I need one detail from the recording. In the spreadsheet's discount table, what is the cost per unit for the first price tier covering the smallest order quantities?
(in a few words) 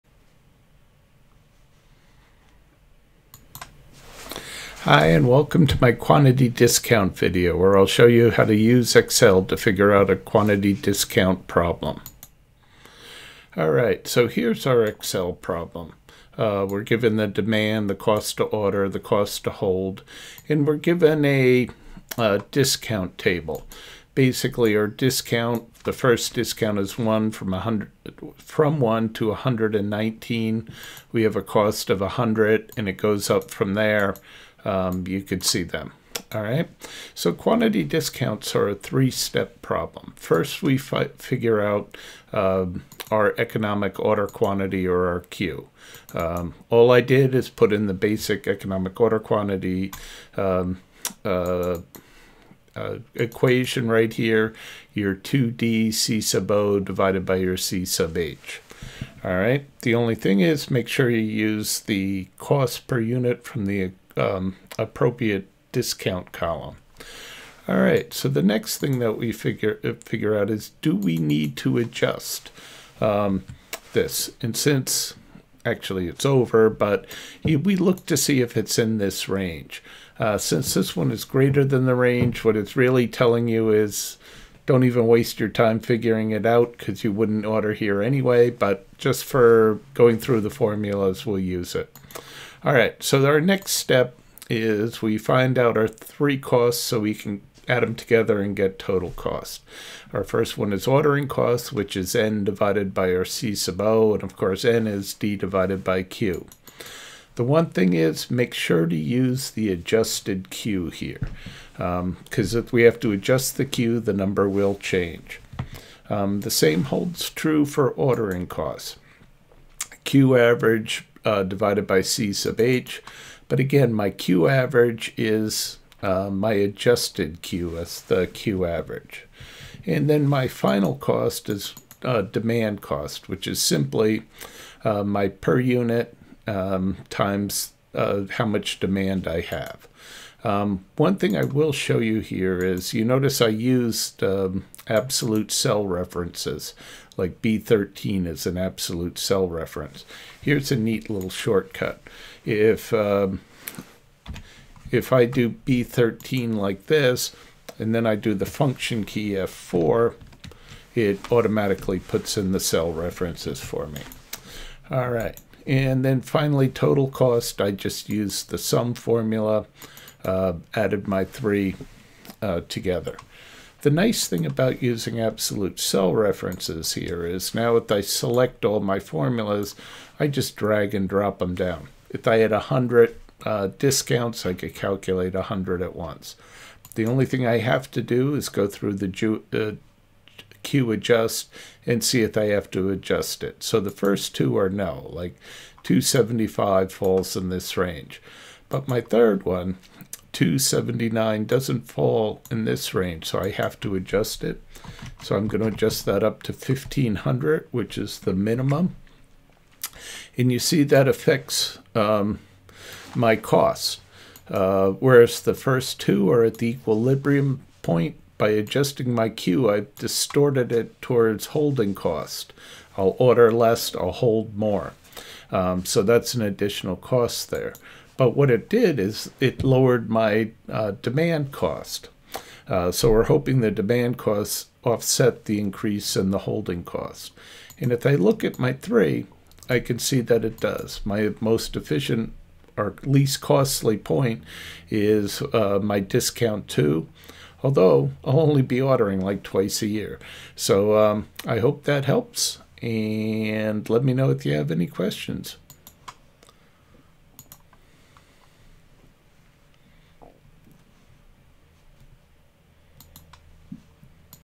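100.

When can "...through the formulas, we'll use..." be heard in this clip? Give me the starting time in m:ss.
1:30.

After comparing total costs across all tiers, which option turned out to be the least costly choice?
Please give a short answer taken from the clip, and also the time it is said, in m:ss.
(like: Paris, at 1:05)
Discount two, at 4:05.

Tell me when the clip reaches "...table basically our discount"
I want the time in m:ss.
0:23.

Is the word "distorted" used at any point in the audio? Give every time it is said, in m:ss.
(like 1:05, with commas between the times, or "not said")
3:39.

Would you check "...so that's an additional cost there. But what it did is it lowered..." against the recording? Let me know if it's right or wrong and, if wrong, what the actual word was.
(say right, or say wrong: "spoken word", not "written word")
right.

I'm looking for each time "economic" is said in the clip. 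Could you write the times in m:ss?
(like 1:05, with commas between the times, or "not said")
0:43, 0:48.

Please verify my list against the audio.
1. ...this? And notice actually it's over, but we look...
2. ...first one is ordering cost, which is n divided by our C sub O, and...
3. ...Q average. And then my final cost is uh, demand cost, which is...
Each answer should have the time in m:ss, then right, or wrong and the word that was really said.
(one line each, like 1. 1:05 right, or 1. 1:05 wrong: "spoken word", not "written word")
1. 1:13 wrong: "since", not "notice"
2. 1:40 right
3. 2:08 right.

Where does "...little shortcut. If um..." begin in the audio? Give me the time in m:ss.
2:31.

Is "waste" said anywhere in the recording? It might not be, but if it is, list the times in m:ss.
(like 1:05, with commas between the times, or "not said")
1:25.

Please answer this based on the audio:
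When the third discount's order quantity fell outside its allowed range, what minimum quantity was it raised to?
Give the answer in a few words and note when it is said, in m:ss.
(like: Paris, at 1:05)
1500, at 3:26.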